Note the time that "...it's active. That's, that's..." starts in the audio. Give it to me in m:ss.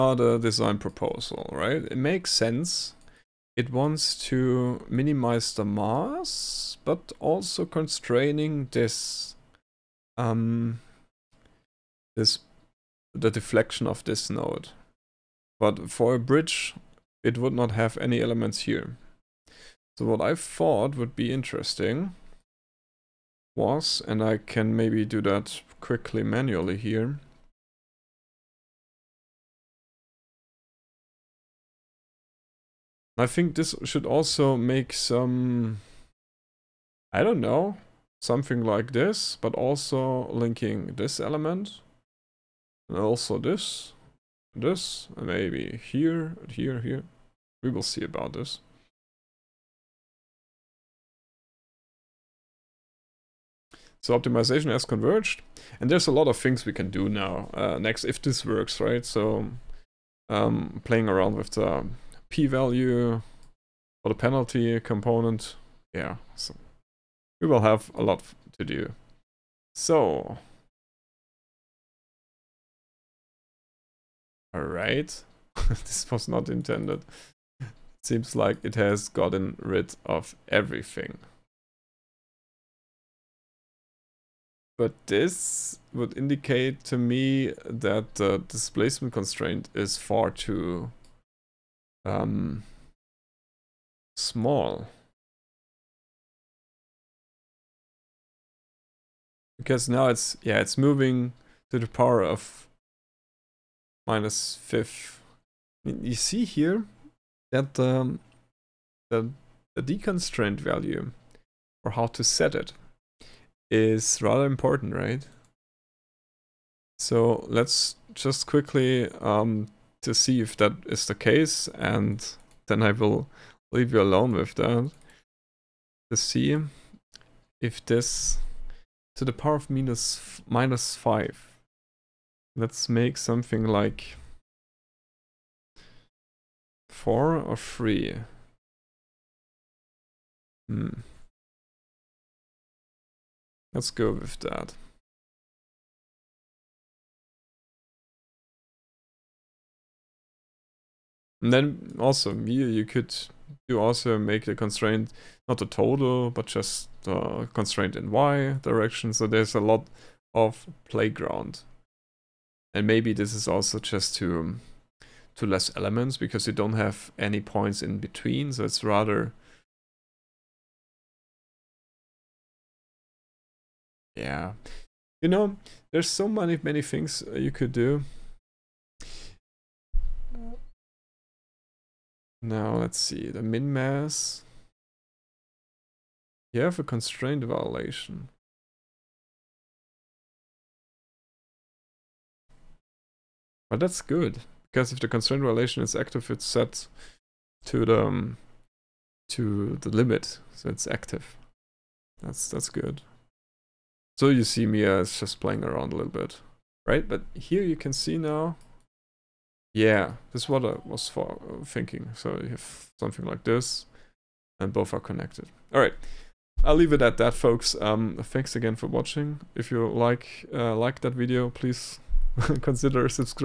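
3:20.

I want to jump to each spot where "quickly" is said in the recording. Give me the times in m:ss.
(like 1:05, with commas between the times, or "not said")
0:25, 1:58.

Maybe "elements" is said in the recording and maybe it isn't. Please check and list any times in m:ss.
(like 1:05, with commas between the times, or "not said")
0:18, 0:41, 2:45.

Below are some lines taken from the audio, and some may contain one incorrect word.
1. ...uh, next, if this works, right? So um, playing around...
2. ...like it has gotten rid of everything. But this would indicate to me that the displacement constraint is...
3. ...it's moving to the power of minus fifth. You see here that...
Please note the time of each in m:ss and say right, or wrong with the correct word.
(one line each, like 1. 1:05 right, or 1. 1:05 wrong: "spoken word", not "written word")
1. 0:57 right
2. 1:18 right
3. 1:40 right.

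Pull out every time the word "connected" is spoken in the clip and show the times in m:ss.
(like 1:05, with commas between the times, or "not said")
3:34.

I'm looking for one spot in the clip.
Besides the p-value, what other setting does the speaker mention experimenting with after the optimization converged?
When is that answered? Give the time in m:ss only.
1:04.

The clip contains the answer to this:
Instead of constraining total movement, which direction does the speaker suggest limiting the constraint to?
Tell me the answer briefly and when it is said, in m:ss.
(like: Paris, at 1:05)
y direction, at 2:38.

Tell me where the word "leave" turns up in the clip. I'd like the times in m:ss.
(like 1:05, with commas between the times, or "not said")
2:03, 3:36.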